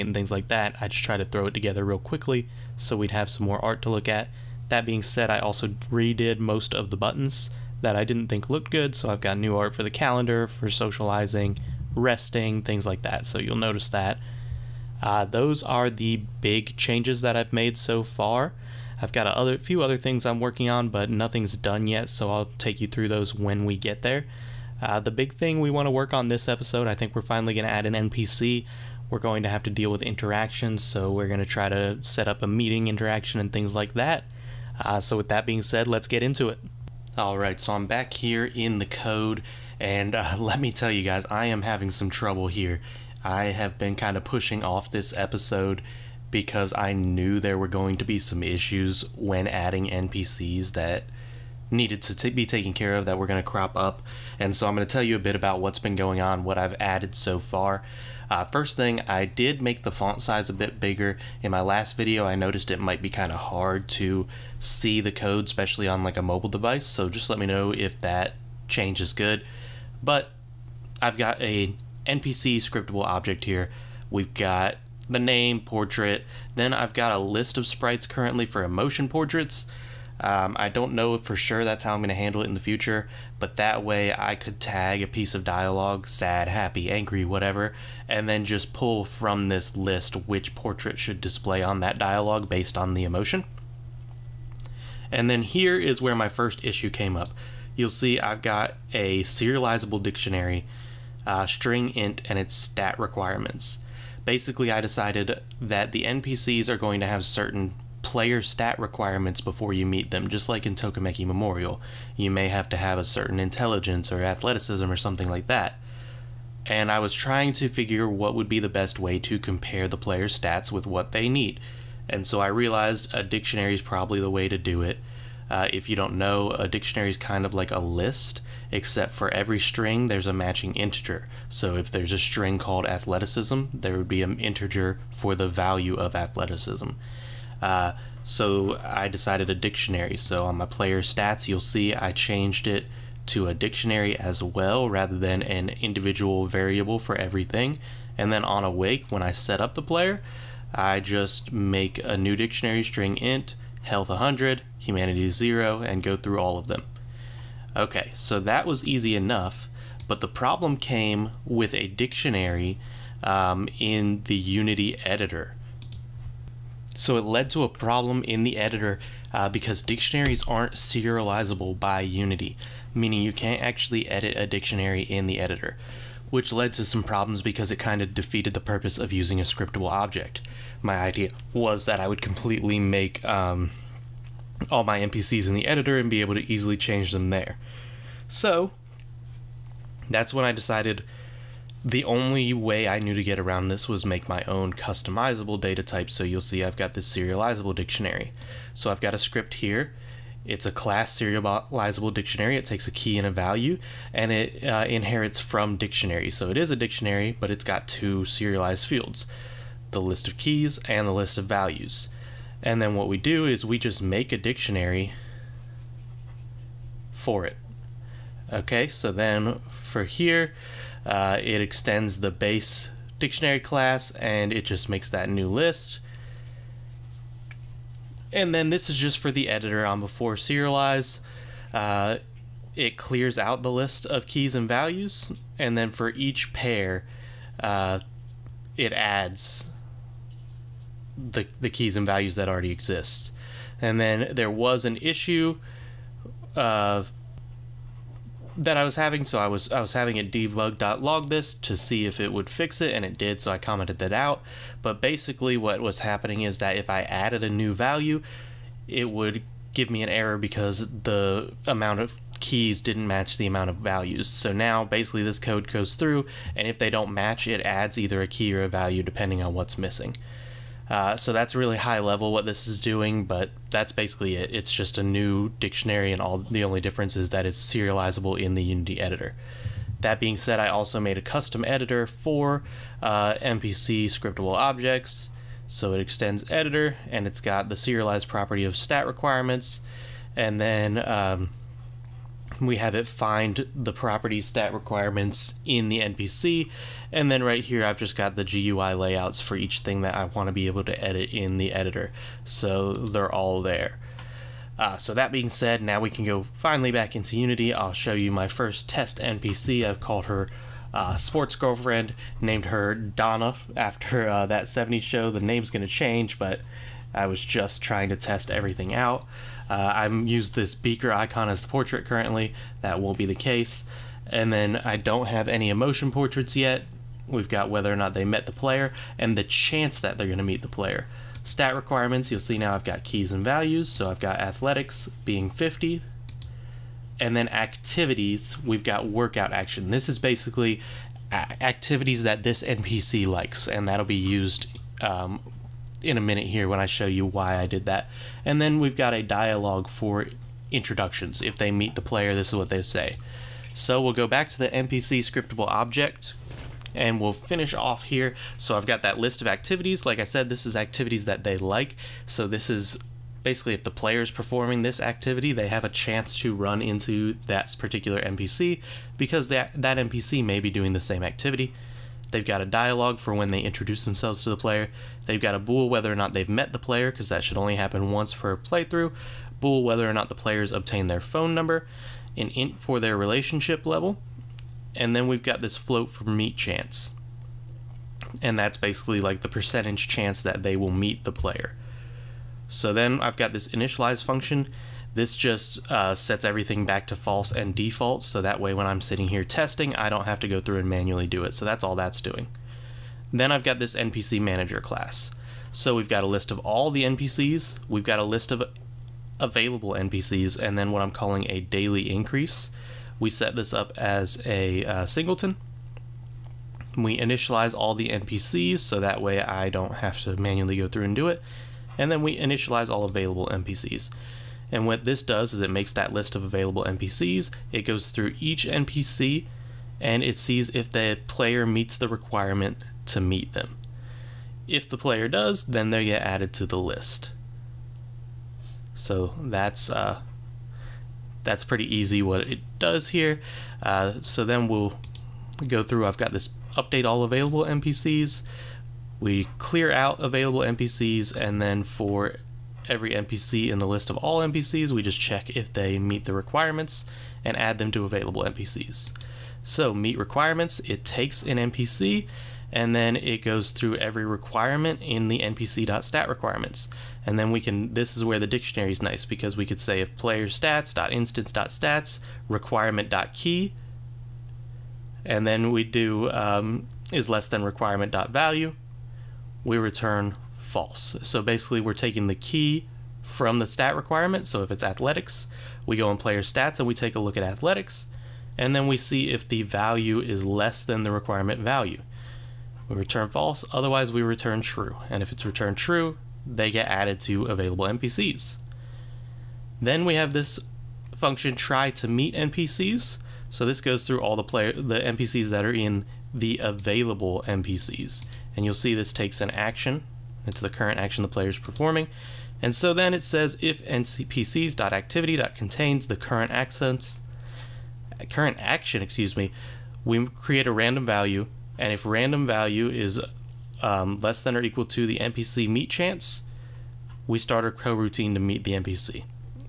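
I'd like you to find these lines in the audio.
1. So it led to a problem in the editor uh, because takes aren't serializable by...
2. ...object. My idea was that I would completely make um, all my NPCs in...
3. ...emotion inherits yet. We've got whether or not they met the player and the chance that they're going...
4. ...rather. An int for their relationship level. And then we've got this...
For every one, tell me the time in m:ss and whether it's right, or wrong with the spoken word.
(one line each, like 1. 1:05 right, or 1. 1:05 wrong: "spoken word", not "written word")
1. 2:46 wrong: "dictionaries", not "takes"
2. 2:59 right
3. 5:25 wrong: "portraits", not "inherits"
4. 6:21 wrong: "number", not "rather".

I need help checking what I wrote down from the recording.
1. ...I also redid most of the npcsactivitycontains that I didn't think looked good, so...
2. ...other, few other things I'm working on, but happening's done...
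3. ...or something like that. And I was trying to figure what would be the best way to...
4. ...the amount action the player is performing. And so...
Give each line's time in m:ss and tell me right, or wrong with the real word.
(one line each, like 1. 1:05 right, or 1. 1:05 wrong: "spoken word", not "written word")
1. 0:05 wrong: "buttons", not "npcsactivitycontains"
2. 0:19 wrong: "nothing", not "happening"
3. 1:54 right
4. 8:30 wrong: "current", not "amount".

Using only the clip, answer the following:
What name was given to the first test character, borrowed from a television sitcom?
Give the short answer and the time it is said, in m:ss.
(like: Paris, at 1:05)
Donna, at 5:12.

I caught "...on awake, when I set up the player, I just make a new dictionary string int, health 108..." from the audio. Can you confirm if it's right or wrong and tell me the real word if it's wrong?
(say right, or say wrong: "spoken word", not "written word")
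wrong: "100", not "108".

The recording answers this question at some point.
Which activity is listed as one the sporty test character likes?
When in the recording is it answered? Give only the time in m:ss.
5:39.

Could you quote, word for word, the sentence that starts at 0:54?
And so I'm going to tell you a bit about what's been going on, what I've added so far.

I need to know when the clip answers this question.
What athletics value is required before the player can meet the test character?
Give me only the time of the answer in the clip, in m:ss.
5:34.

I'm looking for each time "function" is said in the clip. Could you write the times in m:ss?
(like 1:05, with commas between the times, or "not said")
6:34, 8:21.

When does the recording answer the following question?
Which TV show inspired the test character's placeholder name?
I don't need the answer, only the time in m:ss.
5:14.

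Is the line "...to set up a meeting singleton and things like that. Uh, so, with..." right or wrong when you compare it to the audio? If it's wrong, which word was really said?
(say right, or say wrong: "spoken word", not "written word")
wrong: "interaction", not "singleton".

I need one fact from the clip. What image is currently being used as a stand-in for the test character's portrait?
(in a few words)
beaker icon.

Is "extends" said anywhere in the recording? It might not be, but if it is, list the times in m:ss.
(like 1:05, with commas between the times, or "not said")
3:41, 4:46.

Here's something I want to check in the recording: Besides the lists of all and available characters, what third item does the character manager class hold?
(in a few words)
daily increase.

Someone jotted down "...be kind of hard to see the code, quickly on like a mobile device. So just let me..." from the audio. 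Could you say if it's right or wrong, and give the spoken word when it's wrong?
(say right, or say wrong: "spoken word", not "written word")
wrong: "especially", not "quickly".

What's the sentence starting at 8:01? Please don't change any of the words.
So basically we're taking the key from the stat requirement.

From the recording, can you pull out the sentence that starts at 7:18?
So that's uh, that's pretty easy what it does here.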